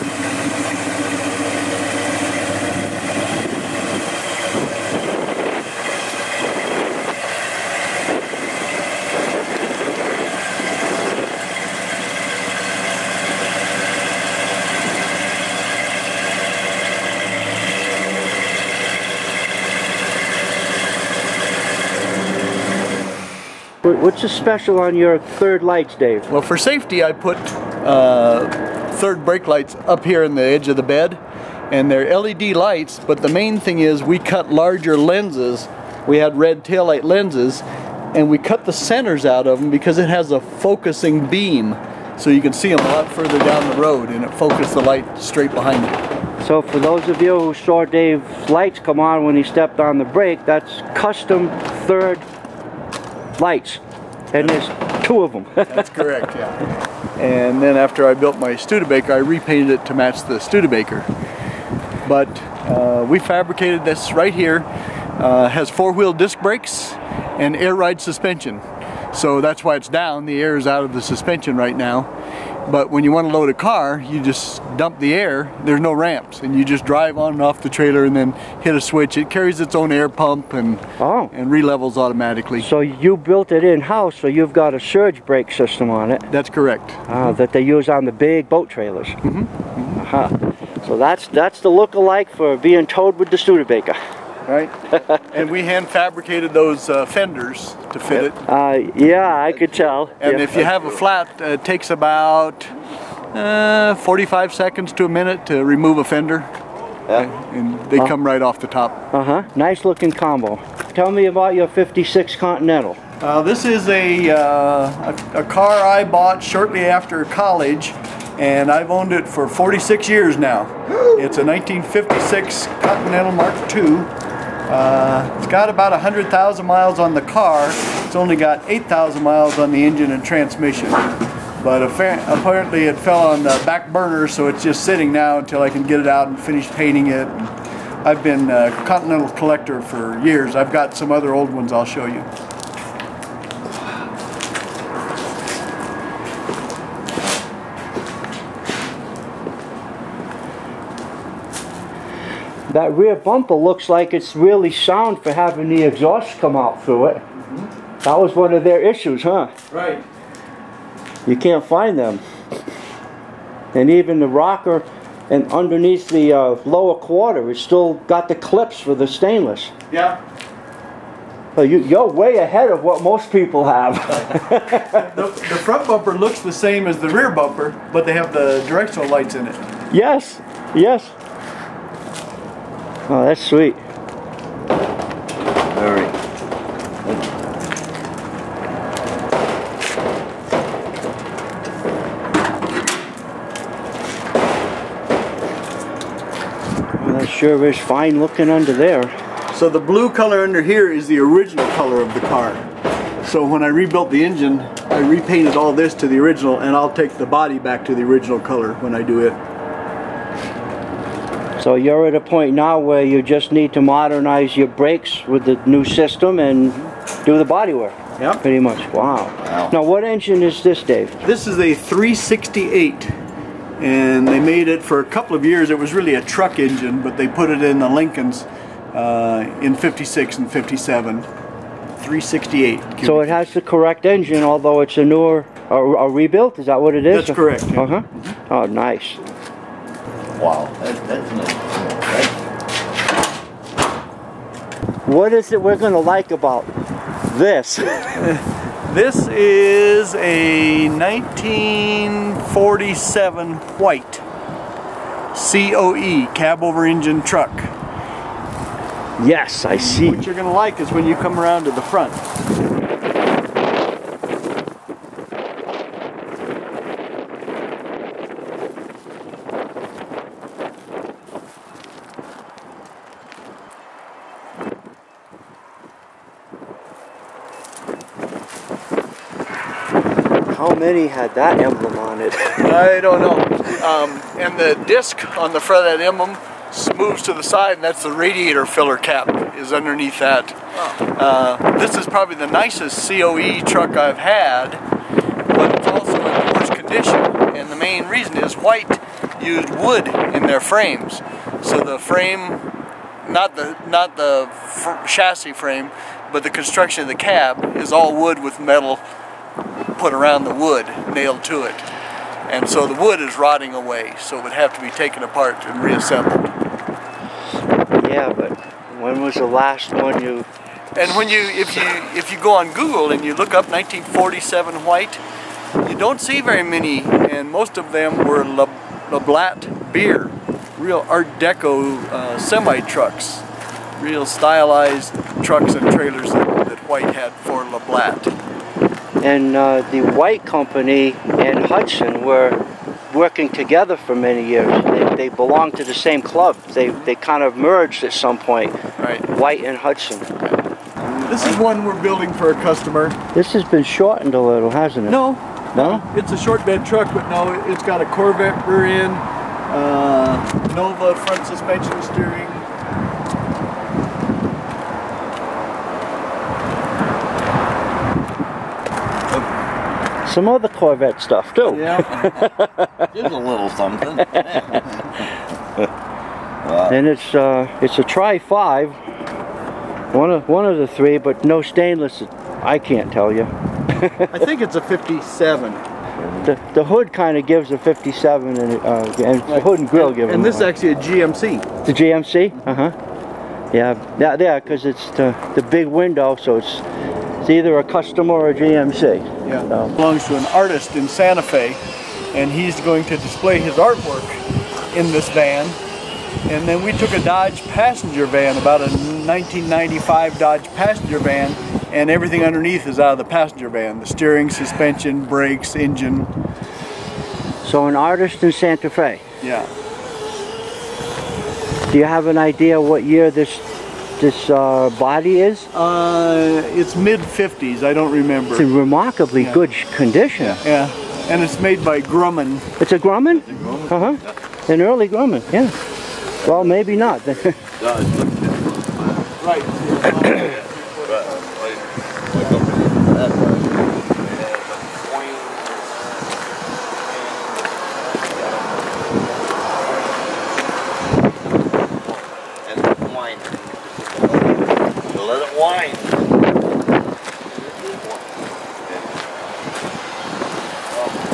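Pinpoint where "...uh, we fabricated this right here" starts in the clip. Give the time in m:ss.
1:02.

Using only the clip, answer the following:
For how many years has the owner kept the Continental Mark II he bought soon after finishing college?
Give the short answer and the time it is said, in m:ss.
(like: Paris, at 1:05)
46, at 1:59.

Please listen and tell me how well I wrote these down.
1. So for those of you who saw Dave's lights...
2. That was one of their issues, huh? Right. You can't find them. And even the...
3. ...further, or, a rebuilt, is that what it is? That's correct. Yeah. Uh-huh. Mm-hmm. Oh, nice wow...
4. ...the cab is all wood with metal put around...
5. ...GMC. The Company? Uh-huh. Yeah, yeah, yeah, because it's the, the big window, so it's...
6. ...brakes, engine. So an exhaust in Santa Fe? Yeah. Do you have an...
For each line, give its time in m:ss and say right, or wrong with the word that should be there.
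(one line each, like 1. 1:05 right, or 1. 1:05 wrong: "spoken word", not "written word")
1. 0:46 right
2. 2:38 right
3. 3:55 wrong: "newer", not "further"
4. 5:07 right
5. 6:30 wrong: "GMC", not "Company"
6. 6:55 wrong: "artist", not "exhaust".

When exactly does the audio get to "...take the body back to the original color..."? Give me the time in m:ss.
3:26.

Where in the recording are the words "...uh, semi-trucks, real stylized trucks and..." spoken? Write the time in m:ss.
5:32.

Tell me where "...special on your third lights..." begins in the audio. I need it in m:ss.
0:24.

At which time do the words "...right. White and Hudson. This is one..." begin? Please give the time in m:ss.
5:48.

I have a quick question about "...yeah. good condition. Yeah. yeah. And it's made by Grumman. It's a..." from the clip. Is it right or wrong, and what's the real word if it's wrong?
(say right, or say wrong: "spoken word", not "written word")
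right.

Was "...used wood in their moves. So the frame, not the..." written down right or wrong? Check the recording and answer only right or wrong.
wrong.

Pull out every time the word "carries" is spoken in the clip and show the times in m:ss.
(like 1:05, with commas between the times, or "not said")
1:19.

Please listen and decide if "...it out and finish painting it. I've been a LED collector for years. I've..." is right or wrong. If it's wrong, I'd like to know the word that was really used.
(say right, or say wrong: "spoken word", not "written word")
wrong: "Continental", not "LED".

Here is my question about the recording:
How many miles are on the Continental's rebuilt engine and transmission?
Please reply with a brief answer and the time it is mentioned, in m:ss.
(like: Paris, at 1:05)
8,000, at 2:08.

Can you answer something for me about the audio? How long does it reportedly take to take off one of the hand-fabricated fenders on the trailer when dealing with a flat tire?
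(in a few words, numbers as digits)
45 seconds to a minute.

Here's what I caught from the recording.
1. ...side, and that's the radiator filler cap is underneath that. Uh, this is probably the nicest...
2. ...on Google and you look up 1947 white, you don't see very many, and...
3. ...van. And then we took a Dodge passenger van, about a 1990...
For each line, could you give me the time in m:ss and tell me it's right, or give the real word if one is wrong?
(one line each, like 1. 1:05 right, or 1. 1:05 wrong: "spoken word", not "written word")
1. 4:47 right
2. 5:22 right
3. 6:45 wrong: "1995", not "1990".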